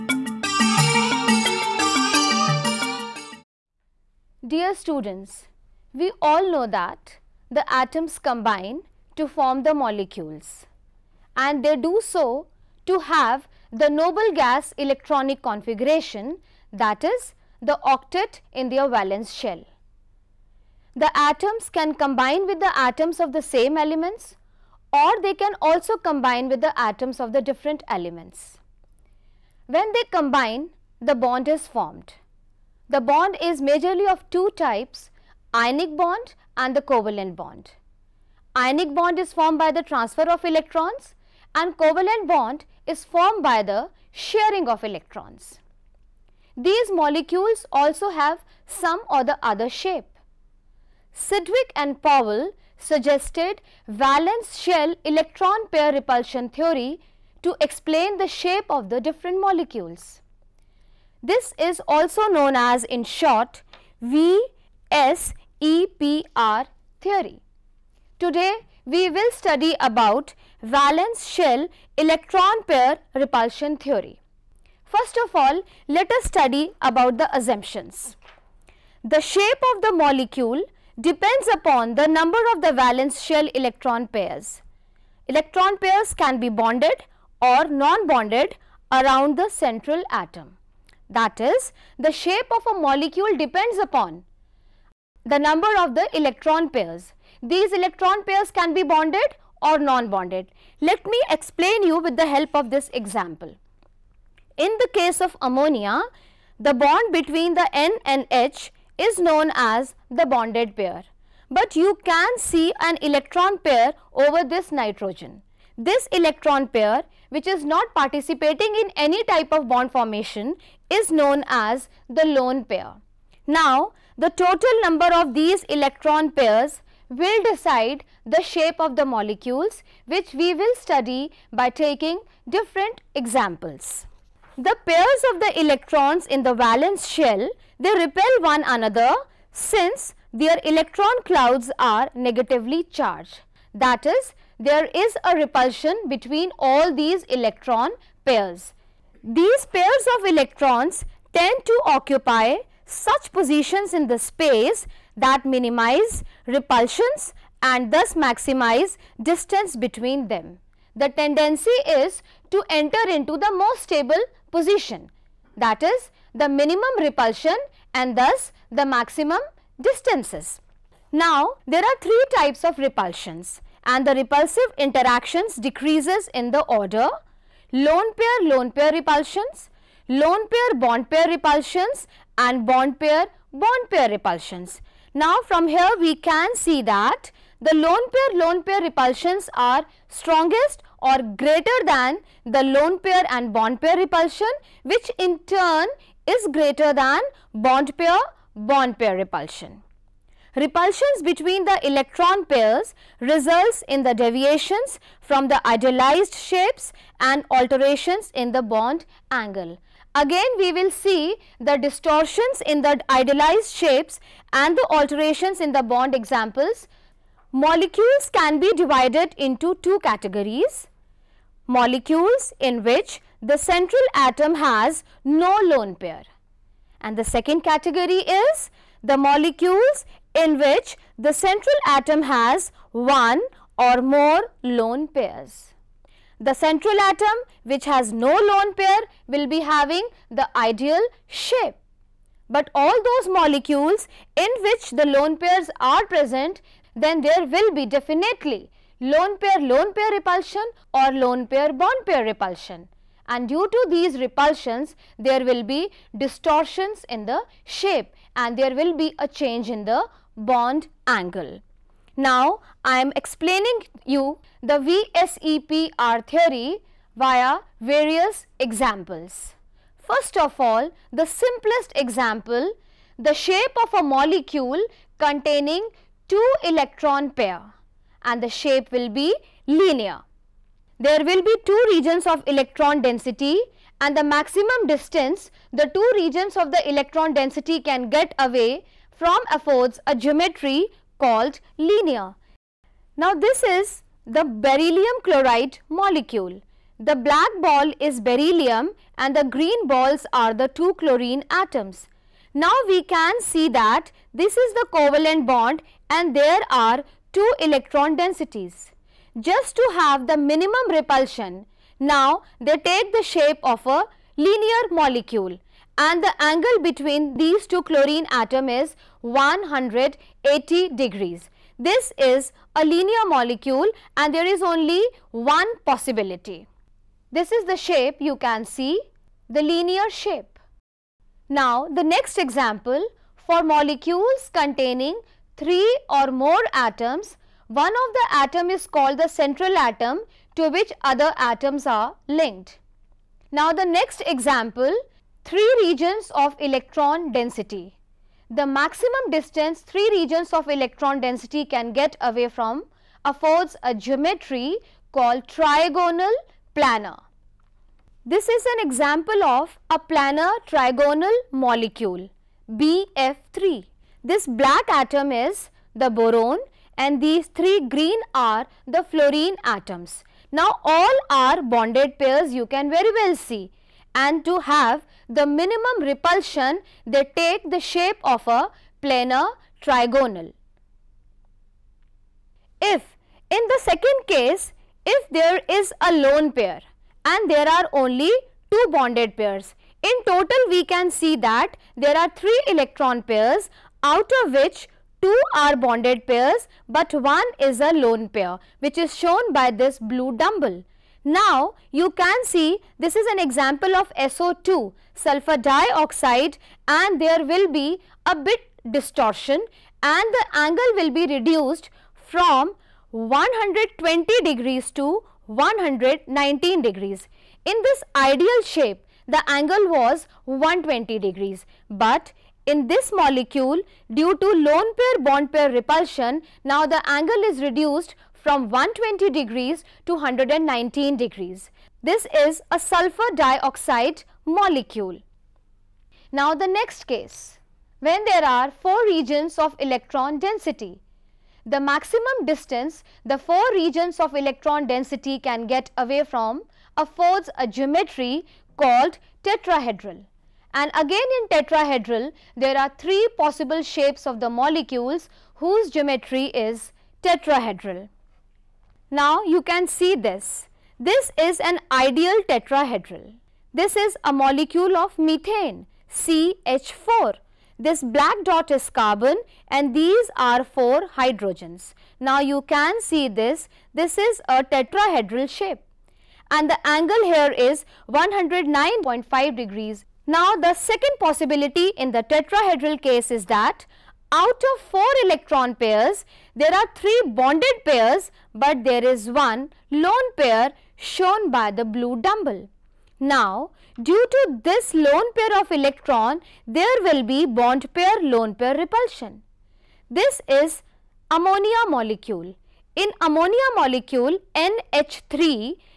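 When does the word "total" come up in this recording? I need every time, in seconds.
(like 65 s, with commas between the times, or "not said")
124 s, 390 s.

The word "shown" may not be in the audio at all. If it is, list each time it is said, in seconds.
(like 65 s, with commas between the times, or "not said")
399 s, 490 s.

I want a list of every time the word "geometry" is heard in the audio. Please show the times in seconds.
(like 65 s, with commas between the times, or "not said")
290 s, 353 s, 447 s, 455 s.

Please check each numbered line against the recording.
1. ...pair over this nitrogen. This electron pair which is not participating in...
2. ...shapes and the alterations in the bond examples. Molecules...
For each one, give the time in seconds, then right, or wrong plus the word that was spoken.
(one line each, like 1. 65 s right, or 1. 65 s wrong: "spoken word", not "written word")
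1. 113 s right
2. 213 s right.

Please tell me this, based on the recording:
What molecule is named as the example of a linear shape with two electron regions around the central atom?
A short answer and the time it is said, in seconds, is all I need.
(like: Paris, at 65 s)
Beryllium chloride, at 294 s.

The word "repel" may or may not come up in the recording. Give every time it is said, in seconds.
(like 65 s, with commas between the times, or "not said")
137 s.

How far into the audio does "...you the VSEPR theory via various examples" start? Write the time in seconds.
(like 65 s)
264 s.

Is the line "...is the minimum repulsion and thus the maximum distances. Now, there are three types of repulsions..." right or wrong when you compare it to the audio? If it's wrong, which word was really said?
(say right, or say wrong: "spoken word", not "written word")
right.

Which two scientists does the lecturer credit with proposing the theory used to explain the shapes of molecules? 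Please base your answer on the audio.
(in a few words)
Sidgwick and Powell.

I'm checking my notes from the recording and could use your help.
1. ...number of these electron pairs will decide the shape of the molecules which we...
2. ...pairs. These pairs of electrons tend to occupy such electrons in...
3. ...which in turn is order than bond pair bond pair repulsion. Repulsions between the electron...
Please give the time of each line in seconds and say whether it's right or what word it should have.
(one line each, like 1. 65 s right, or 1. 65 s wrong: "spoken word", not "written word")
1. 124 s right
2. 148 s wrong: "positions", not "electrons"
3. 194 s wrong: "greater", not "order".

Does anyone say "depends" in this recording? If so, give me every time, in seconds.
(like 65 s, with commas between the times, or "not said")
81 s, 93 s.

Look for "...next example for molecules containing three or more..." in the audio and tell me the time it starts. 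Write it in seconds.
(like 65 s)
332 s.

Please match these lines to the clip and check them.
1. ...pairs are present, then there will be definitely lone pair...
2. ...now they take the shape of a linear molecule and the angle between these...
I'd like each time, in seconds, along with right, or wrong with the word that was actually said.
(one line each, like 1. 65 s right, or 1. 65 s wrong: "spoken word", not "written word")
1. 245 s right
2. 311 s right.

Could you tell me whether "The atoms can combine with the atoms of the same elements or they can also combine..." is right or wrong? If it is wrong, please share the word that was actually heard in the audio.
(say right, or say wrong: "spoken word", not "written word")
right.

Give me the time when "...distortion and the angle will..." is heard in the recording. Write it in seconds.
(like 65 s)
408 s.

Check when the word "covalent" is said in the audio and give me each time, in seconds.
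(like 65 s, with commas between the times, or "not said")
36 s, 41 s, 304 s.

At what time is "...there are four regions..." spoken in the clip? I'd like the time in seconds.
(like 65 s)
438 s.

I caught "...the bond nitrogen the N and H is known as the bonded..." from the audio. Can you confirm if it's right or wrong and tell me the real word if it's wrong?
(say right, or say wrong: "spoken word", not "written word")
wrong: "between", not "nitrogen".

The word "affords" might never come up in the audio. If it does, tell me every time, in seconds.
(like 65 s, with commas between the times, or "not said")
289 s, 353 s, 447 s.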